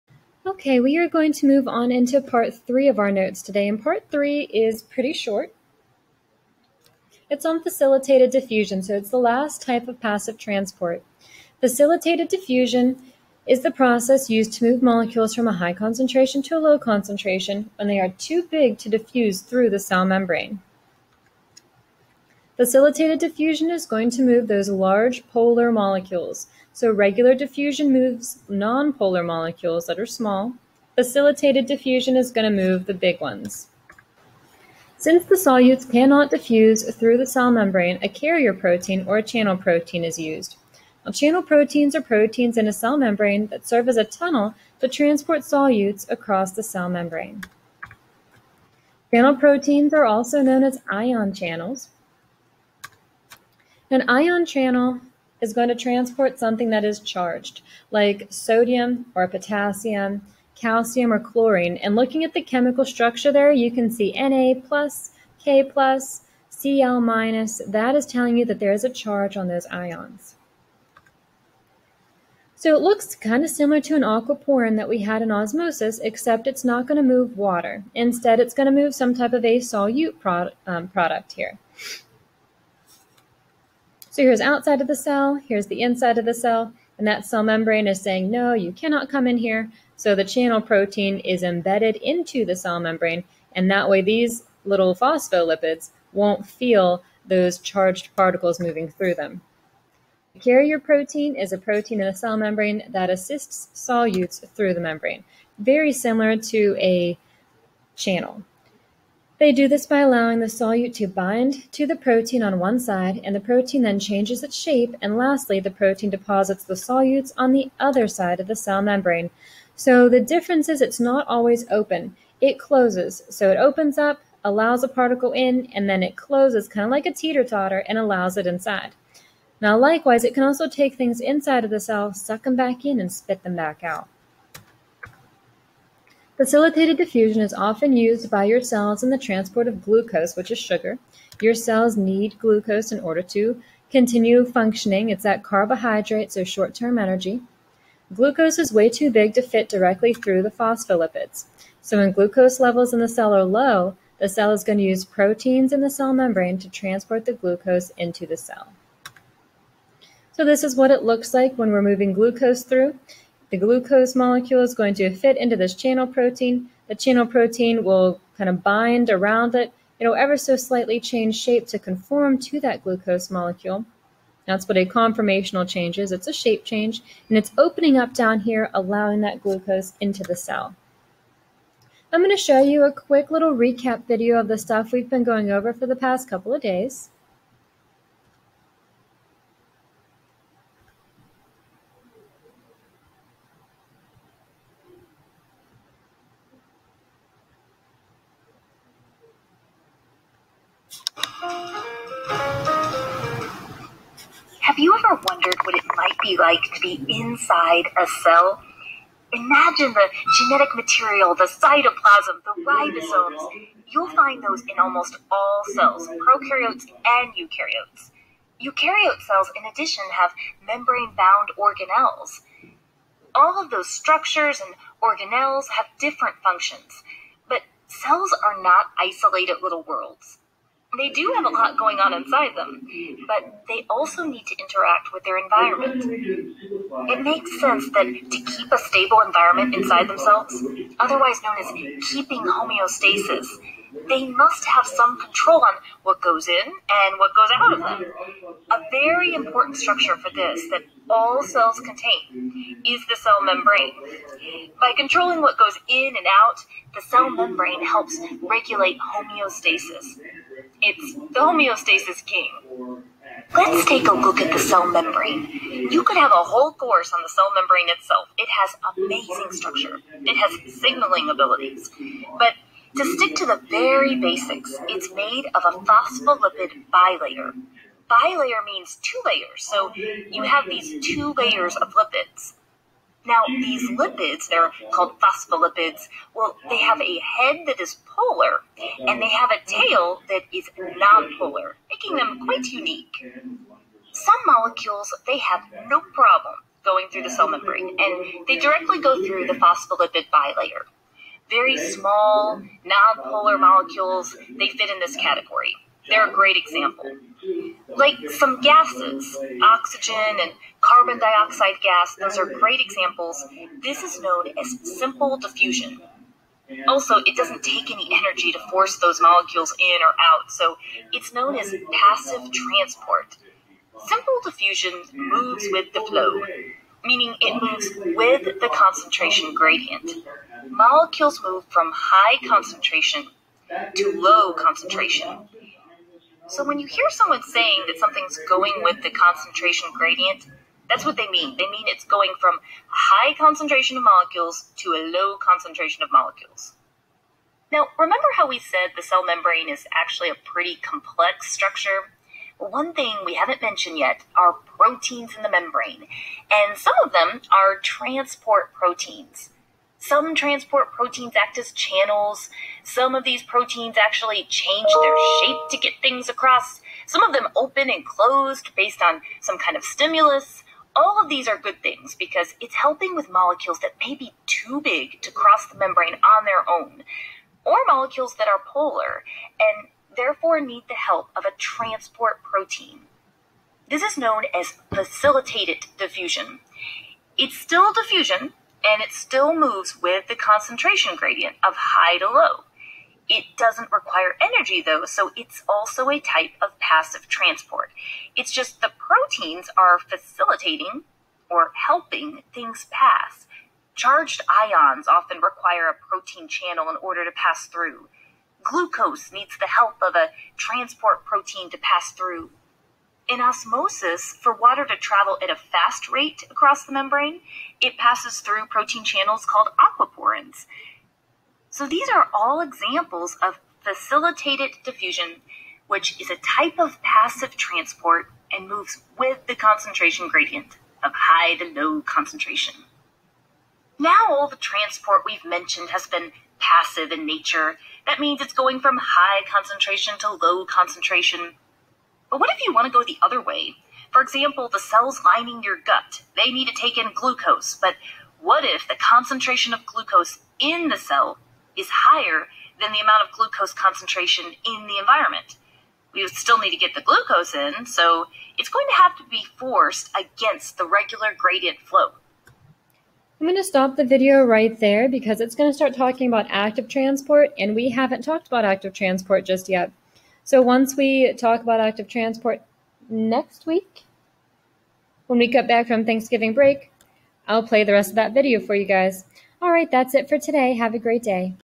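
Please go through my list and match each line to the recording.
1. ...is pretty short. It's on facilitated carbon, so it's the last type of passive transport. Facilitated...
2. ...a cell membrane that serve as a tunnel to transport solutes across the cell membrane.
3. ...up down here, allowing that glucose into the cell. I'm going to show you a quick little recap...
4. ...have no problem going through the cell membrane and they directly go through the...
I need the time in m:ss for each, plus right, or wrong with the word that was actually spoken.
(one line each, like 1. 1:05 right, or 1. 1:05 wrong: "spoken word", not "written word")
1. 0:04 wrong: "diffusion", not "carbon"
2. 0:42 right
3. 2:57 right
4. 4:55 right.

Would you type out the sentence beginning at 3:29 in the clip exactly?
Imagine the genetic material, the cytoplasm, the ribosomes.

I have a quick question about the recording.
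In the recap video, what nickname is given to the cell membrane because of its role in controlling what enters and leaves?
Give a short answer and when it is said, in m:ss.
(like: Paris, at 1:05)
the homeostasis king, at 4:21.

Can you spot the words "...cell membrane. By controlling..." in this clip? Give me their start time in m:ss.
4:13.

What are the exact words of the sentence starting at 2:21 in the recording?
Your cells need glucose in order to continue functioning.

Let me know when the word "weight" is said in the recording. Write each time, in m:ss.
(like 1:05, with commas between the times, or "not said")
not said.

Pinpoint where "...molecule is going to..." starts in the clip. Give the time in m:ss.
2:44.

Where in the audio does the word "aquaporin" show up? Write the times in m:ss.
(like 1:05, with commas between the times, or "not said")
1:14, 6:59.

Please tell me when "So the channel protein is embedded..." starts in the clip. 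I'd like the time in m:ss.
1:29.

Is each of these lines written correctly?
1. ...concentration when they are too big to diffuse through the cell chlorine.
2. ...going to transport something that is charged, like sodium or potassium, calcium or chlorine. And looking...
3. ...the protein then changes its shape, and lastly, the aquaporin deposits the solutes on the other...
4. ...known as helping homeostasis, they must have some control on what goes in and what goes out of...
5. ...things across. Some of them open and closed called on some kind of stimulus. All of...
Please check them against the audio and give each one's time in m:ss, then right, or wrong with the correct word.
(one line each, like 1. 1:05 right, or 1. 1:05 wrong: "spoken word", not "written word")
1. 0:16 wrong: "membrane", not "chlorine"
2. 0:55 right
3. 1:53 wrong: "protein", not "aquaporin"
4. 4:01 wrong: "keeping", not "helping"
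5. 6:06 wrong: "based", not "called".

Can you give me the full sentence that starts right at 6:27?
It's still diffusion and it still moves with the concentration gradient of high to low.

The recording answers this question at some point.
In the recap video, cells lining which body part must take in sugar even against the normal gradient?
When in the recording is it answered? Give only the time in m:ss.
7:25.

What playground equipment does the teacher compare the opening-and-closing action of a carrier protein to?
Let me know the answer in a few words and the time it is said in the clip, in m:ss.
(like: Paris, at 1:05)
teeter-totter, at 2:07.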